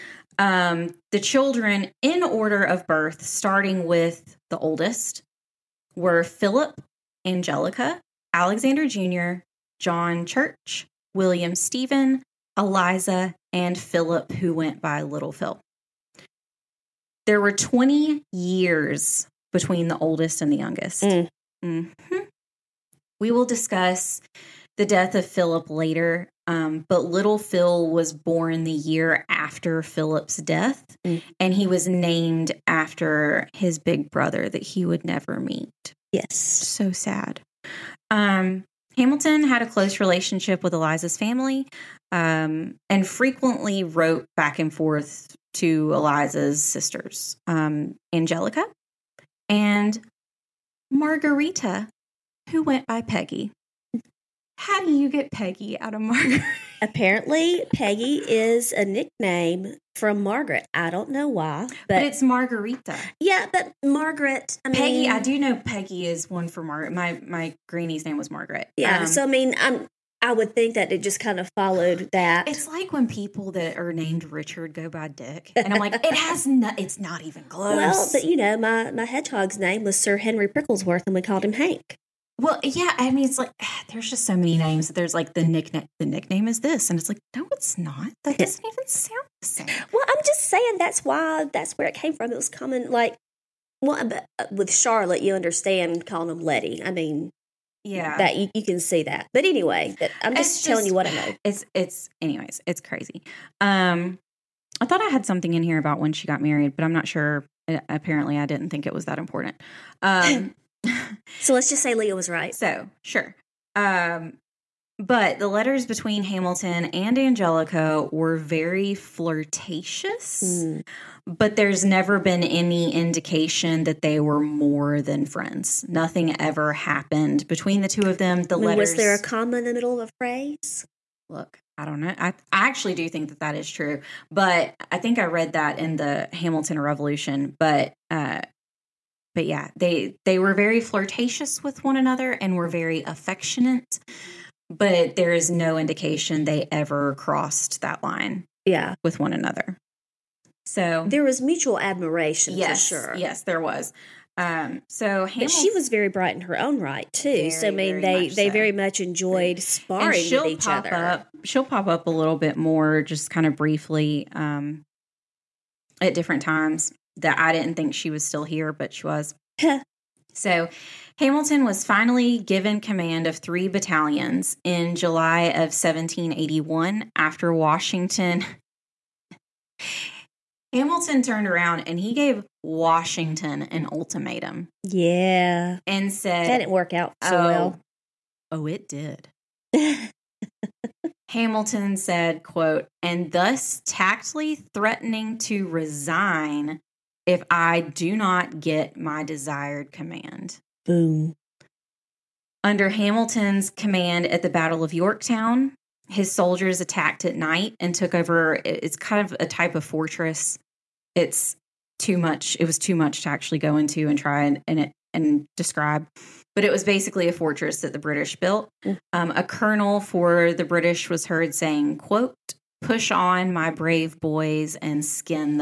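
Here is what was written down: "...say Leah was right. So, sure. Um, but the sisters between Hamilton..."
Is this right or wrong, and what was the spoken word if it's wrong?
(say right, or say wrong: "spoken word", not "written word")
wrong: "letters", not "sisters".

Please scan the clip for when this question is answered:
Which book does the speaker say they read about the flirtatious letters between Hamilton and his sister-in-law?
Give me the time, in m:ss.
2:15.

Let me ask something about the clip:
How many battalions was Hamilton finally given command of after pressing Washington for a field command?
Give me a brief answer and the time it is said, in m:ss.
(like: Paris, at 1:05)
3, at 2:53.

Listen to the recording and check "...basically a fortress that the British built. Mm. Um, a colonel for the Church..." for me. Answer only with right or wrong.
wrong.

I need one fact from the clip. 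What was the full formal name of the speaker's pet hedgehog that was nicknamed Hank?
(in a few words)
Sir Henry Pricklesworth.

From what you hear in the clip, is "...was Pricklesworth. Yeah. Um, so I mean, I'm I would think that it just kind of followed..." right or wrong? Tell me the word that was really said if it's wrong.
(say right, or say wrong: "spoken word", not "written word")
wrong: "Margaret", not "Pricklesworth".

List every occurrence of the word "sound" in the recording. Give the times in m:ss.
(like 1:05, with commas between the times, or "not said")
1:28.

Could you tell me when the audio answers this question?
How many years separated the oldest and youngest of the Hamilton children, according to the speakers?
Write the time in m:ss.
0:17.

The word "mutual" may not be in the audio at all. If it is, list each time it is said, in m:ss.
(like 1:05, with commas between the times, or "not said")
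2:31.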